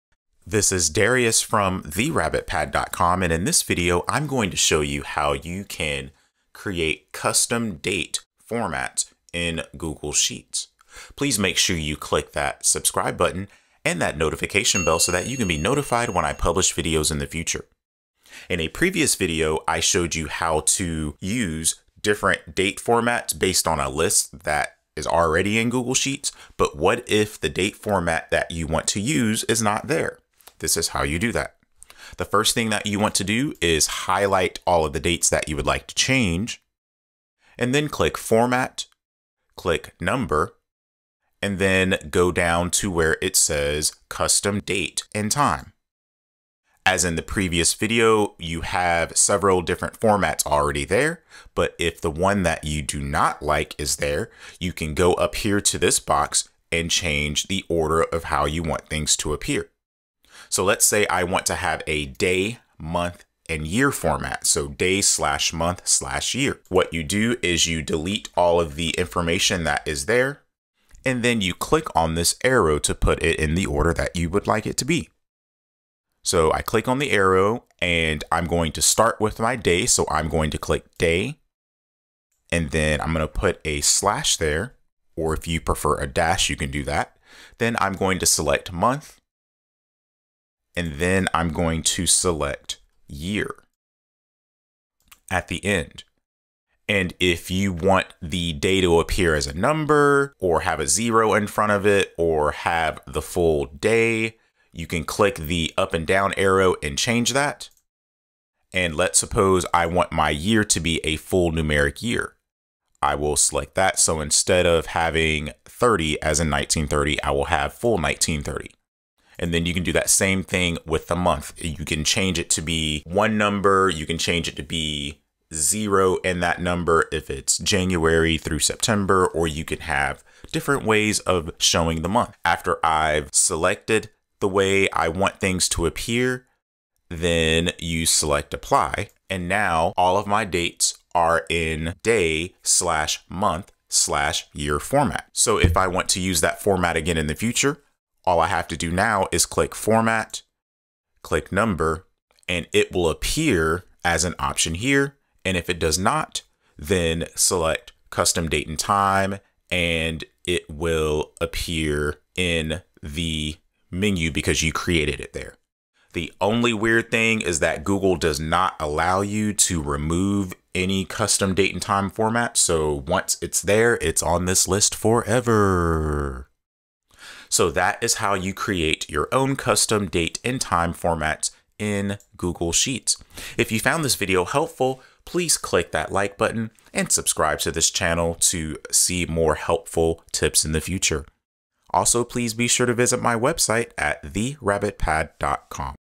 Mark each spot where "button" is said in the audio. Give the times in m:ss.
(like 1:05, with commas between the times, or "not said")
0:13, 3:06.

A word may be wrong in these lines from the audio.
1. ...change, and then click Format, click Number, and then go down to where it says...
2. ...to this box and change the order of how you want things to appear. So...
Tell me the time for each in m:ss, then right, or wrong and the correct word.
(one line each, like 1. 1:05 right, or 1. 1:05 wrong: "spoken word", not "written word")
1. 0:35 right
2. 0:55 right.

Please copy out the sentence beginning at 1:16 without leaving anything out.
So I click on the arrow and I'm going to start with my day.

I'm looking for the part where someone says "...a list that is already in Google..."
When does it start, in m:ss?
0:23.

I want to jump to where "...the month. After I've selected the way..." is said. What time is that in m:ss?
2:12.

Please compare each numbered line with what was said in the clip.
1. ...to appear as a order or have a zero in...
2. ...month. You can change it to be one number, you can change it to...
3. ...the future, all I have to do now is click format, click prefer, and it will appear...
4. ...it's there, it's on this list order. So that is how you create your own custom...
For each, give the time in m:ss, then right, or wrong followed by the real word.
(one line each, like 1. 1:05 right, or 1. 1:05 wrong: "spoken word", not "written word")
1. 1:38 wrong: "number", not "order"
2. 2:01 right
3. 2:27 wrong: "number", not "prefer"
4. 2:53 wrong: "forever", not "order".